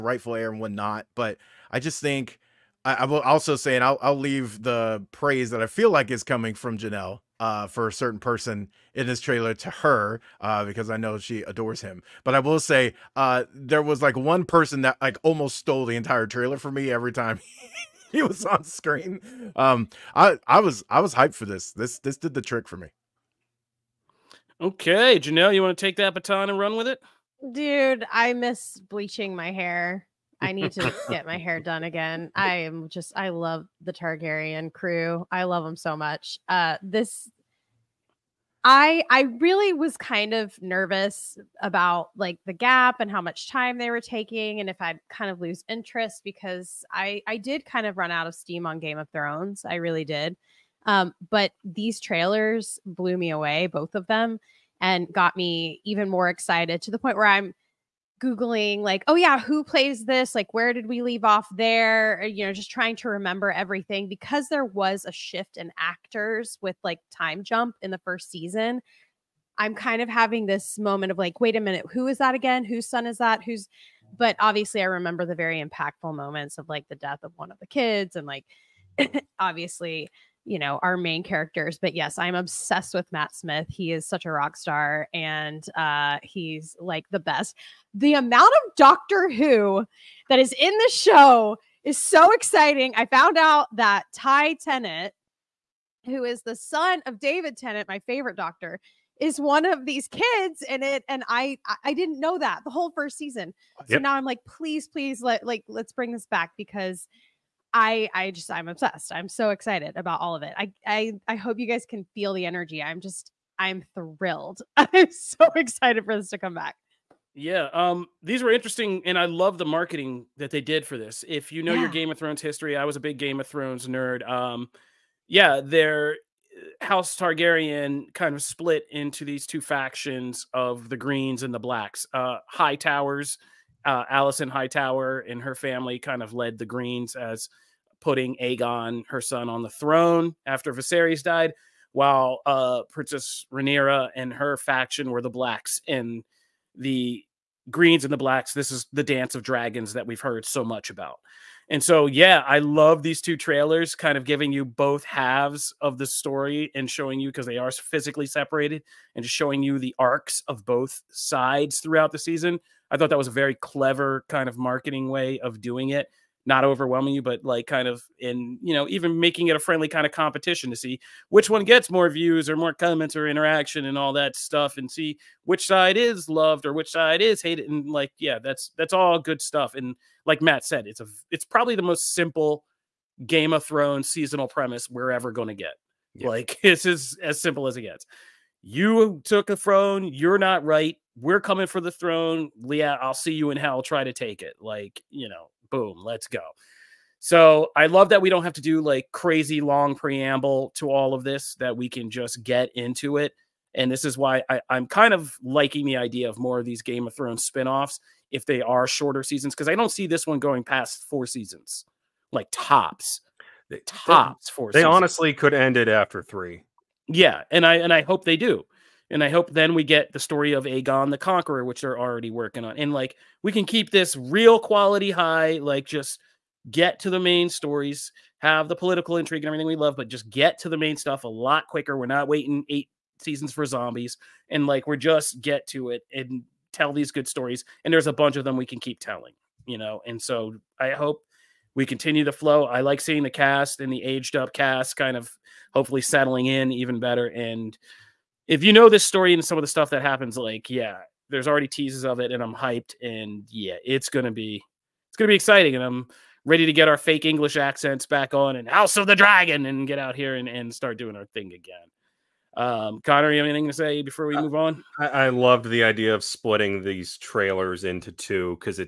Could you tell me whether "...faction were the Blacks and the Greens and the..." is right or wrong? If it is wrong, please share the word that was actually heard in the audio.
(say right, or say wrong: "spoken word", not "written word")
right.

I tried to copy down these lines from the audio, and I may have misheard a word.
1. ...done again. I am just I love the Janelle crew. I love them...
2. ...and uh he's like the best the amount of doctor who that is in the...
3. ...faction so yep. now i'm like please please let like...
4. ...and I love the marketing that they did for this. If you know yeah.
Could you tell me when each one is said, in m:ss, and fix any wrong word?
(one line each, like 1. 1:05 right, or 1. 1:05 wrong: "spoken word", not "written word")
1. 0:31 wrong: "Targaryen", not "Janelle"
2. 1:25 right
3. 1:43 wrong: "season", not "faction"
4. 1:59 right.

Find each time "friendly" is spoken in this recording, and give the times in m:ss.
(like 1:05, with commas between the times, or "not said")
2:49.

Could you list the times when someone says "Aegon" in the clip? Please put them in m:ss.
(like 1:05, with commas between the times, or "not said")
2:18, 3:40.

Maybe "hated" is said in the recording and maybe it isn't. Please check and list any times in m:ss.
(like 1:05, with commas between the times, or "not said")
2:57.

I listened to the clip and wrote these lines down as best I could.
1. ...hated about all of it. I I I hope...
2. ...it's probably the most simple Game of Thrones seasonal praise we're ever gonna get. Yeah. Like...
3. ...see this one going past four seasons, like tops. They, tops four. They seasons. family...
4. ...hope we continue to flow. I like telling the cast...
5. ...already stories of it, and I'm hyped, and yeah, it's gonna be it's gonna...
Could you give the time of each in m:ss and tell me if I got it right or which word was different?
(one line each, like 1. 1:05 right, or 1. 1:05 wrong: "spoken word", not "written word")
1. 1:49 wrong: "excited", not "hated"
2. 3:01 wrong: "premise", not "praise"
3. 3:29 wrong: "honestly", not "family"
4. 4:00 wrong: "seeing", not "telling"
5. 4:11 wrong: "teases", not "stories".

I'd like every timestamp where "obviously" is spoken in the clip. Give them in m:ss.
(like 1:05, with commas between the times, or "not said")
1:14, 1:19.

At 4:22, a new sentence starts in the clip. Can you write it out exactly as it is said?
Um, Connor, you have anything to say before we uh, move on?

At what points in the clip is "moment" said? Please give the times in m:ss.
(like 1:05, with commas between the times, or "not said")
1:10, 1:16.